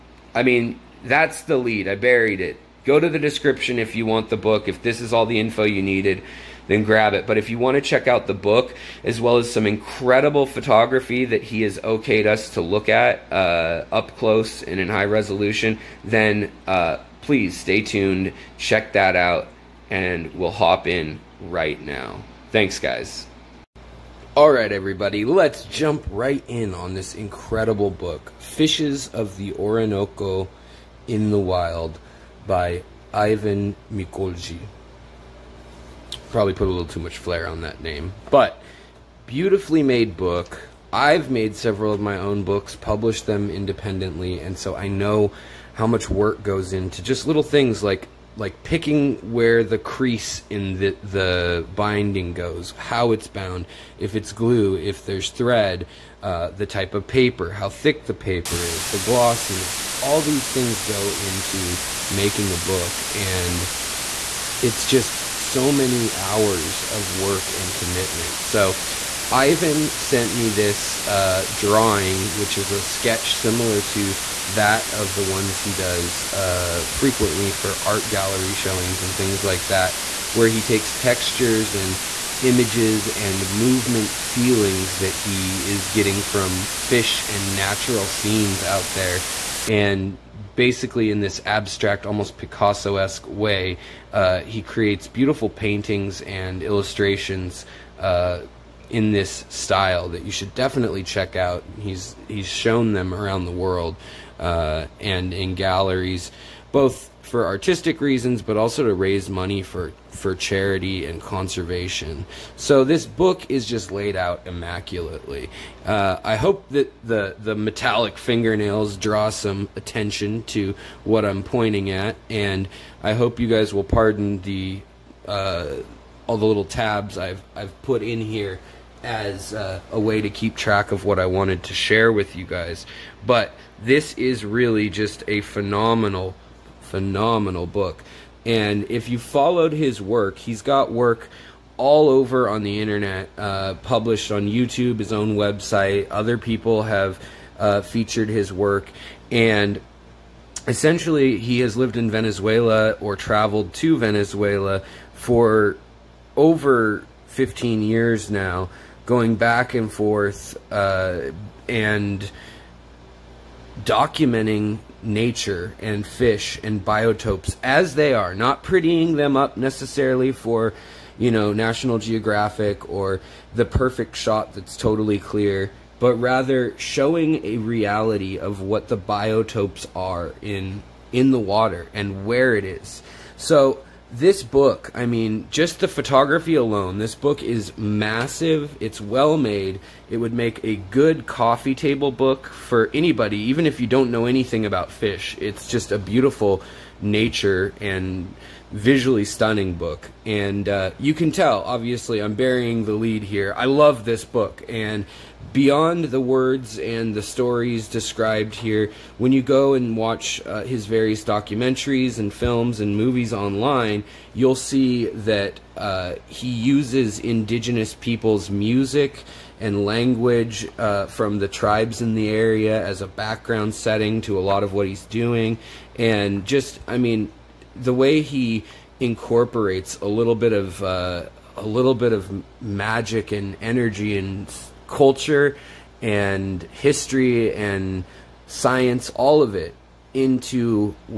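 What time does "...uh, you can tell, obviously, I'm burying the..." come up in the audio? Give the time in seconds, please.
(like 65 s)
200 s.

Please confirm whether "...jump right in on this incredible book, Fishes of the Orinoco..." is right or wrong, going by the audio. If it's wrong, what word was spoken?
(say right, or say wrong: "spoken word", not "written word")
right.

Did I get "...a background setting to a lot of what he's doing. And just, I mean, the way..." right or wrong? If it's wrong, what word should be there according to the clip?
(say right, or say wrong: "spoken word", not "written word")
right.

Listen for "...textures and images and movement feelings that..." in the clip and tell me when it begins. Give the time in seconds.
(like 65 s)
80 s.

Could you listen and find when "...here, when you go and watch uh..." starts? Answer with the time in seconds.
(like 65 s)
208 s.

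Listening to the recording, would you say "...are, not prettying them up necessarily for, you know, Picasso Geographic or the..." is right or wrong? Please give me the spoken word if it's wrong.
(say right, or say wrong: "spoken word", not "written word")
wrong: "National", not "Picasso".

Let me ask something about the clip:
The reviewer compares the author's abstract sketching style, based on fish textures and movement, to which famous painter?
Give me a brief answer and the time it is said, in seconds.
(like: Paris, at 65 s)
Picasso, at 92 s.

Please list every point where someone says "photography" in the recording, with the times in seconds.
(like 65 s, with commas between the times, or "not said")
10 s, 185 s.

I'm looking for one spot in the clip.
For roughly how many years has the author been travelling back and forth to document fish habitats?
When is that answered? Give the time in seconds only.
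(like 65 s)
157 s.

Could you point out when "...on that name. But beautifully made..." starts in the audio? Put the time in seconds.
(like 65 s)
37 s.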